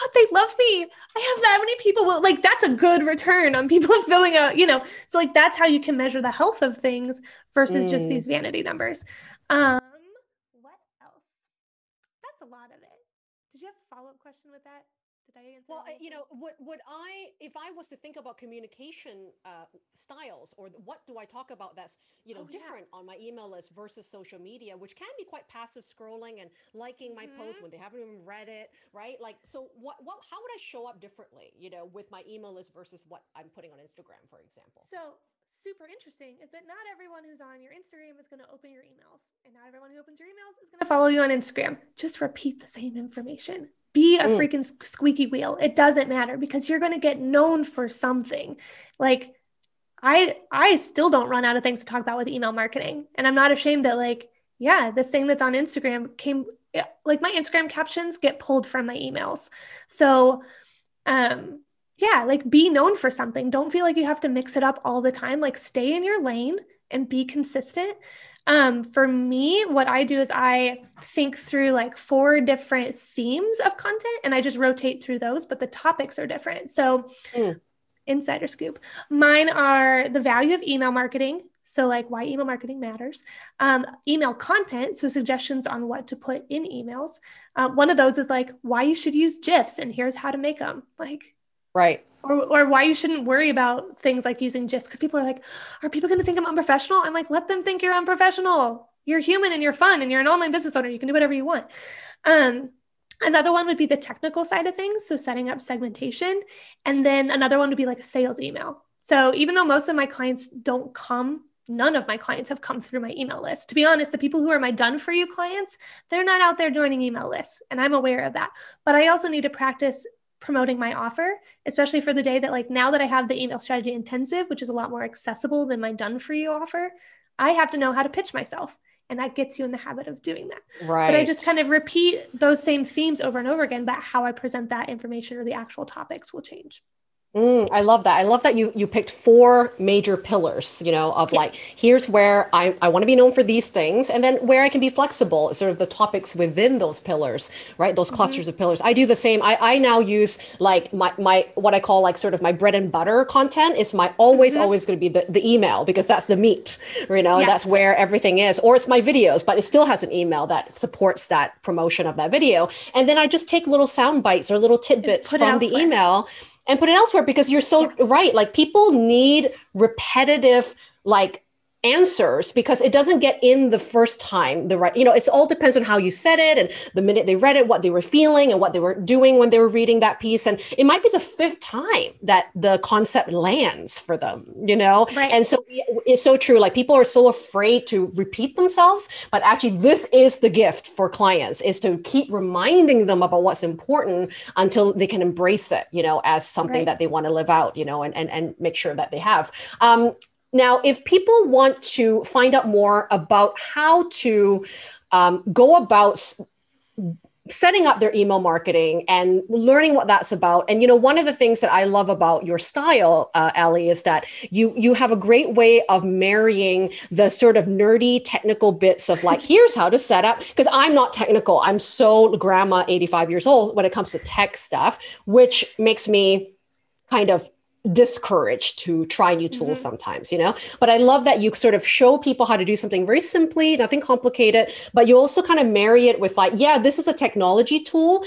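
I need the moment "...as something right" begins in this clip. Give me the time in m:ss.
3:16.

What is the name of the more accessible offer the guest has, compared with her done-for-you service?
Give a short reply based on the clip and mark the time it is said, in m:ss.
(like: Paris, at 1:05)
Email strategy intensive, at 2:03.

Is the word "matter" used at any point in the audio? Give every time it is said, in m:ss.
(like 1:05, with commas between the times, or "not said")
0:46, 1:22.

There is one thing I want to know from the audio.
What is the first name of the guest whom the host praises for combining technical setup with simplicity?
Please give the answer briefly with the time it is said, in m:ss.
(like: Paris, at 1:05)
Allea, at 3:33.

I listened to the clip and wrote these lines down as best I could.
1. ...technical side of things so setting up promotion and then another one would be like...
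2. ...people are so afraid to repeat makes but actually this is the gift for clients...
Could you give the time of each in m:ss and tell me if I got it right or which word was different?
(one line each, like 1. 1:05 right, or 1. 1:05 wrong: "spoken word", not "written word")
1. 1:43 wrong: "segmentation", not "promotion"
2. 3:06 wrong: "themselves", not "makes".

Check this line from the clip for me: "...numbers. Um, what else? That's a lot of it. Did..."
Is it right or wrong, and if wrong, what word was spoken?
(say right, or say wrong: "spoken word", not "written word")
right.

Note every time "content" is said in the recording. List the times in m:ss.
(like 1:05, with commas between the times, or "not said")
1:13, 1:24, 2:33.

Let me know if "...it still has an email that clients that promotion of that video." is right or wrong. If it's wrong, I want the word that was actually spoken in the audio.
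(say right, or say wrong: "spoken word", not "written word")
wrong: "supports", not "clients".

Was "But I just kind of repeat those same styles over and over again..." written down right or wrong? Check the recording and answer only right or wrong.
wrong.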